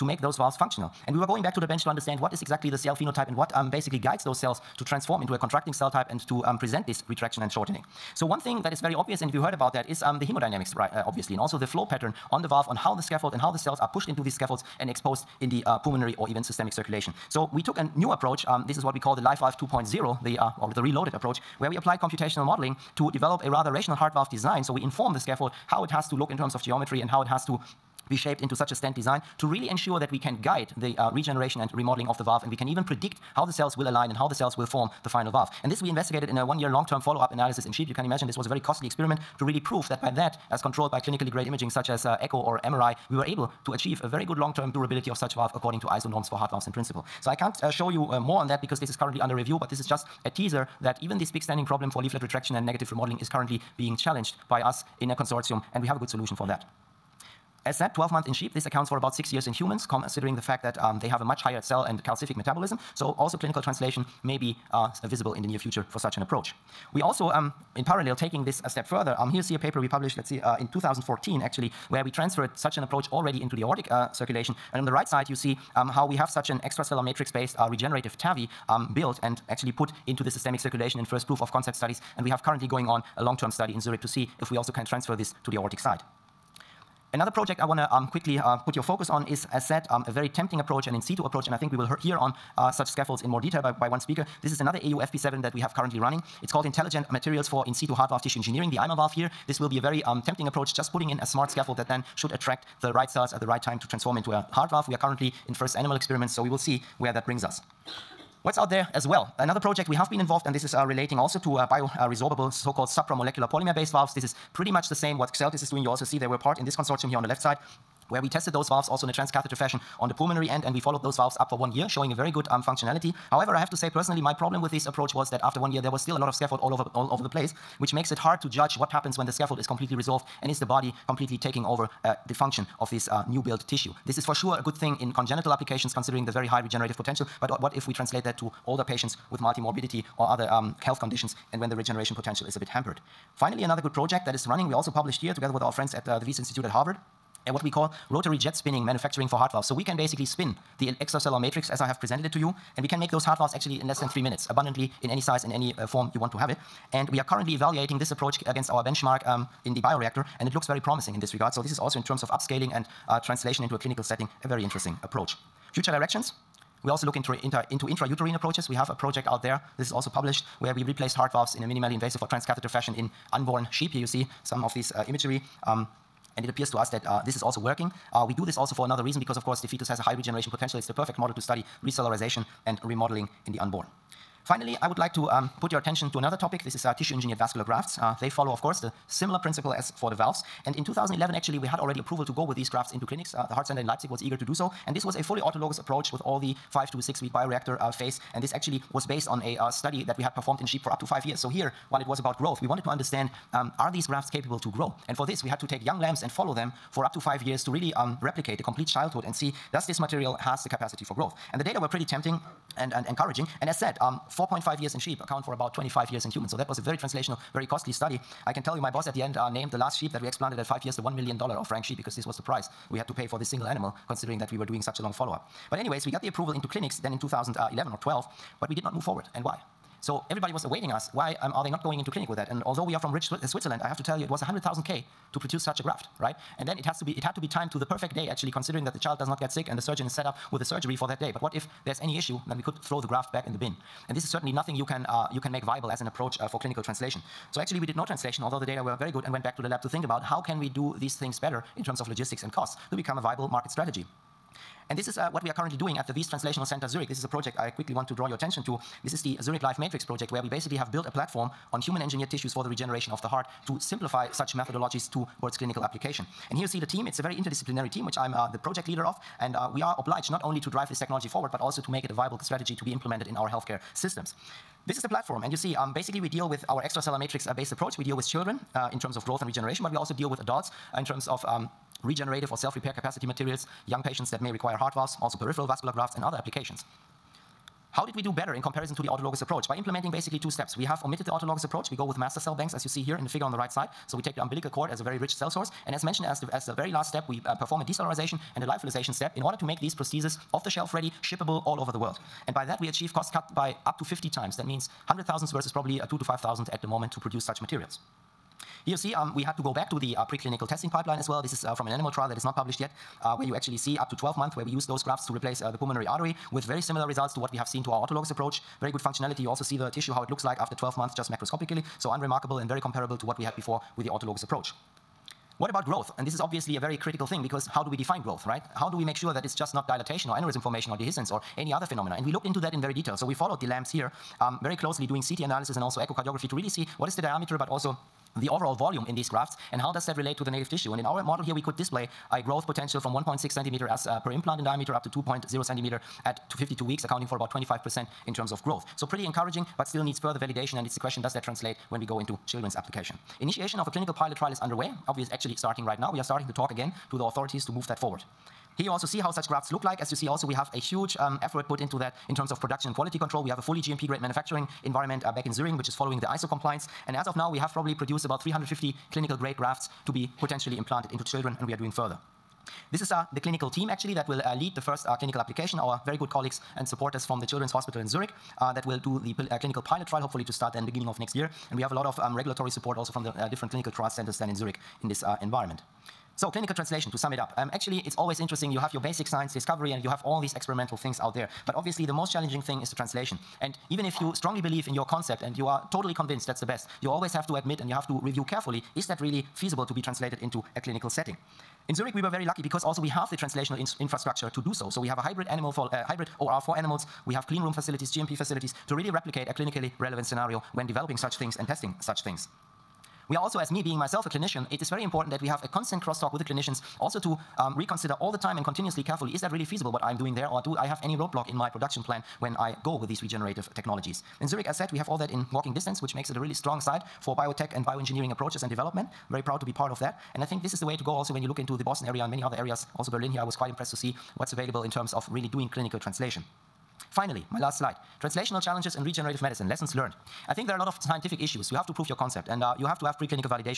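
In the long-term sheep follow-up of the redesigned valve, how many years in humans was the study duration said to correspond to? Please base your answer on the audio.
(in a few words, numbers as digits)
6.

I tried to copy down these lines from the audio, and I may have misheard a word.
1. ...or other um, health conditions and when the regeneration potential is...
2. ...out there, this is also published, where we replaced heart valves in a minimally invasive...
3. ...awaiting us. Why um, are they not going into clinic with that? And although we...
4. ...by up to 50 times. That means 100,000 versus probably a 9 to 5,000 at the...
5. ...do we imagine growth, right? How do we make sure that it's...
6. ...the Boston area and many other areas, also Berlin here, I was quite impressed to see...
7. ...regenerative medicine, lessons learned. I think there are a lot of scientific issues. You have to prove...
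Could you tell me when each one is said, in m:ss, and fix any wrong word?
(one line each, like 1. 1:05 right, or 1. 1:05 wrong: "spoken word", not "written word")
1. 2:20 right
2. 2:49 right
3. 3:50 right
4. 5:03 wrong: "2", not "9"
5. 5:27 wrong: "define", not "imagine"
6. 7:11 right
7. 7:19 right.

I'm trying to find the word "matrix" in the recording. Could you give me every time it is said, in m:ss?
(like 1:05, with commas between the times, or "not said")
1:17, 2:31, 4:19, 4:37.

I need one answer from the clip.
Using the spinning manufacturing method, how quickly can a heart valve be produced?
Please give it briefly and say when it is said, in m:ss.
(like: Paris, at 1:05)
less than 3 minutes, at 2:33.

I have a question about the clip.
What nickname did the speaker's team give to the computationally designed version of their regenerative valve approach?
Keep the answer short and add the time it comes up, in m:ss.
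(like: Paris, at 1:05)
Life Valve 2.0, at 0:19.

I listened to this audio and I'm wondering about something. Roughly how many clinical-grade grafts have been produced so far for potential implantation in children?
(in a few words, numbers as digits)
350.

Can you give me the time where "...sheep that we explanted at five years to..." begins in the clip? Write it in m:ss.
3:39.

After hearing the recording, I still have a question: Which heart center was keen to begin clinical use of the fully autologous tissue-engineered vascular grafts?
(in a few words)
Leipzig.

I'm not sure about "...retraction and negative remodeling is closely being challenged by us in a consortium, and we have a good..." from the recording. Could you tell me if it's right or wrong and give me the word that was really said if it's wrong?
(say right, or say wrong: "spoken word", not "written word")
wrong: "currently", not "closely".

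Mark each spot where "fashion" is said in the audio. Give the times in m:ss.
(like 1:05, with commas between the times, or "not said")
1:59, 2:52.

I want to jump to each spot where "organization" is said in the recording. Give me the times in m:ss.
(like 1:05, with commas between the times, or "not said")
not said.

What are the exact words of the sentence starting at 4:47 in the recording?
How did we do better in comparison to the autologous approach?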